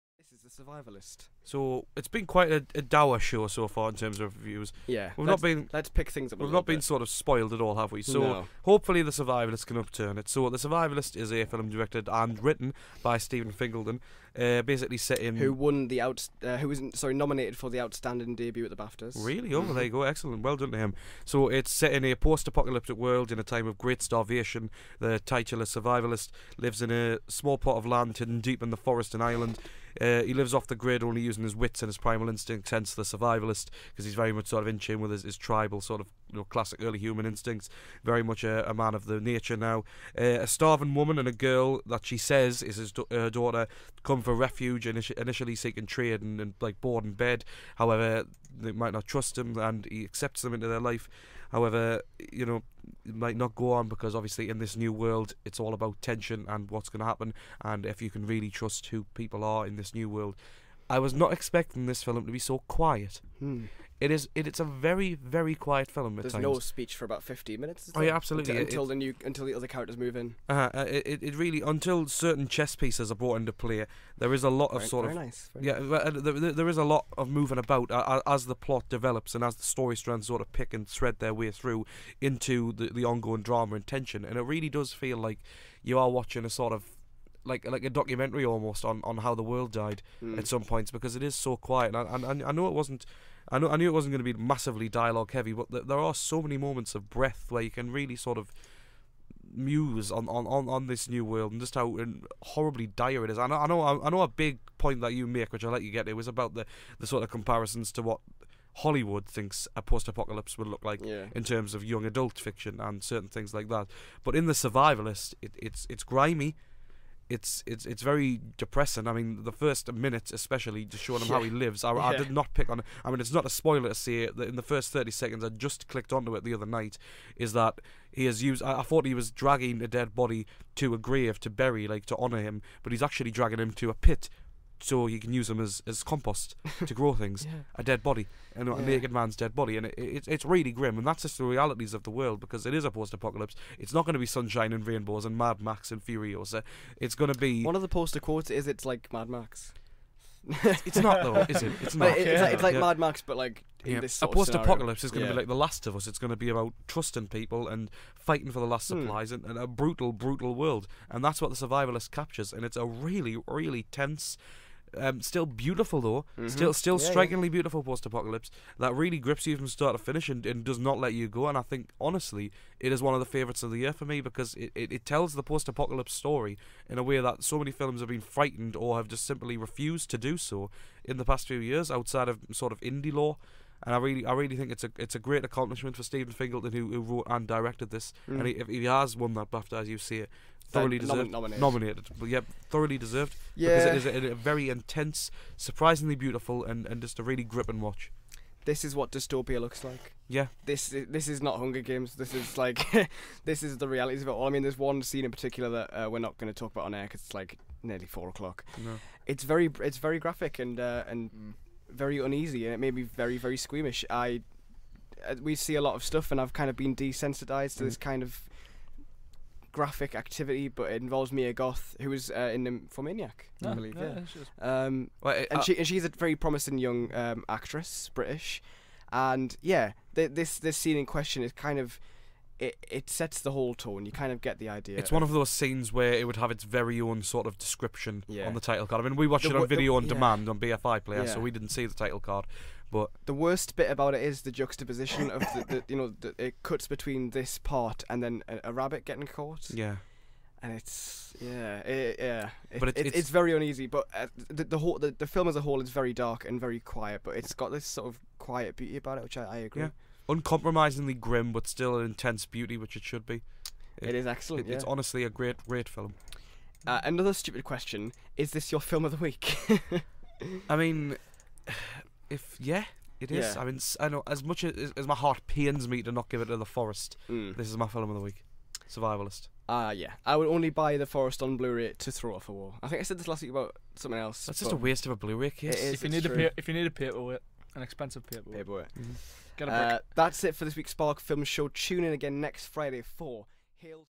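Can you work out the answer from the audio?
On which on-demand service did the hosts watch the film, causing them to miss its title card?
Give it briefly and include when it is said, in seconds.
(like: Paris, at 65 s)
BFI Player, at 240 s.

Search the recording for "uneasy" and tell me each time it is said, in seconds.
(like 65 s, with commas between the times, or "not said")
212 s, 253 s.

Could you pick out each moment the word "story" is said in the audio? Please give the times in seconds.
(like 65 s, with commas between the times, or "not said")
79 s, 176 s.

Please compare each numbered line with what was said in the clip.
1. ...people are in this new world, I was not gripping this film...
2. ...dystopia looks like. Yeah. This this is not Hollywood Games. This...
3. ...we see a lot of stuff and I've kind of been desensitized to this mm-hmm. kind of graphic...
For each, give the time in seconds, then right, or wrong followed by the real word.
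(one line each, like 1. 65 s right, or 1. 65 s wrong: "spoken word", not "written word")
1. 59 s wrong: "expecting", not "gripping"
2. 199 s wrong: "Hunger", not "Hollywood"
3. 215 s right.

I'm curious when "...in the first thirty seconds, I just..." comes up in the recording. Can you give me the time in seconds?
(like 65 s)
124 s.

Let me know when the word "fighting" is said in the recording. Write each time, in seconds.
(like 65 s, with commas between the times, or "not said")
158 s.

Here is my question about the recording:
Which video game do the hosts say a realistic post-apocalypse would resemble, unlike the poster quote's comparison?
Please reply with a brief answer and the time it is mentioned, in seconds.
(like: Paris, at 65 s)
The Last of Us, at 155 s.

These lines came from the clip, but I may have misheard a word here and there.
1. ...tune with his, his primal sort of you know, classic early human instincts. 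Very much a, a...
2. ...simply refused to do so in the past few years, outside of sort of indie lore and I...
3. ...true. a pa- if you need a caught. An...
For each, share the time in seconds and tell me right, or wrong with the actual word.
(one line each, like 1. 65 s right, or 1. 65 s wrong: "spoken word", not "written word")
1. 34 s wrong: "tribal", not "primal"
2. 179 s right
3. 286 s wrong: "paperweight", not "caught".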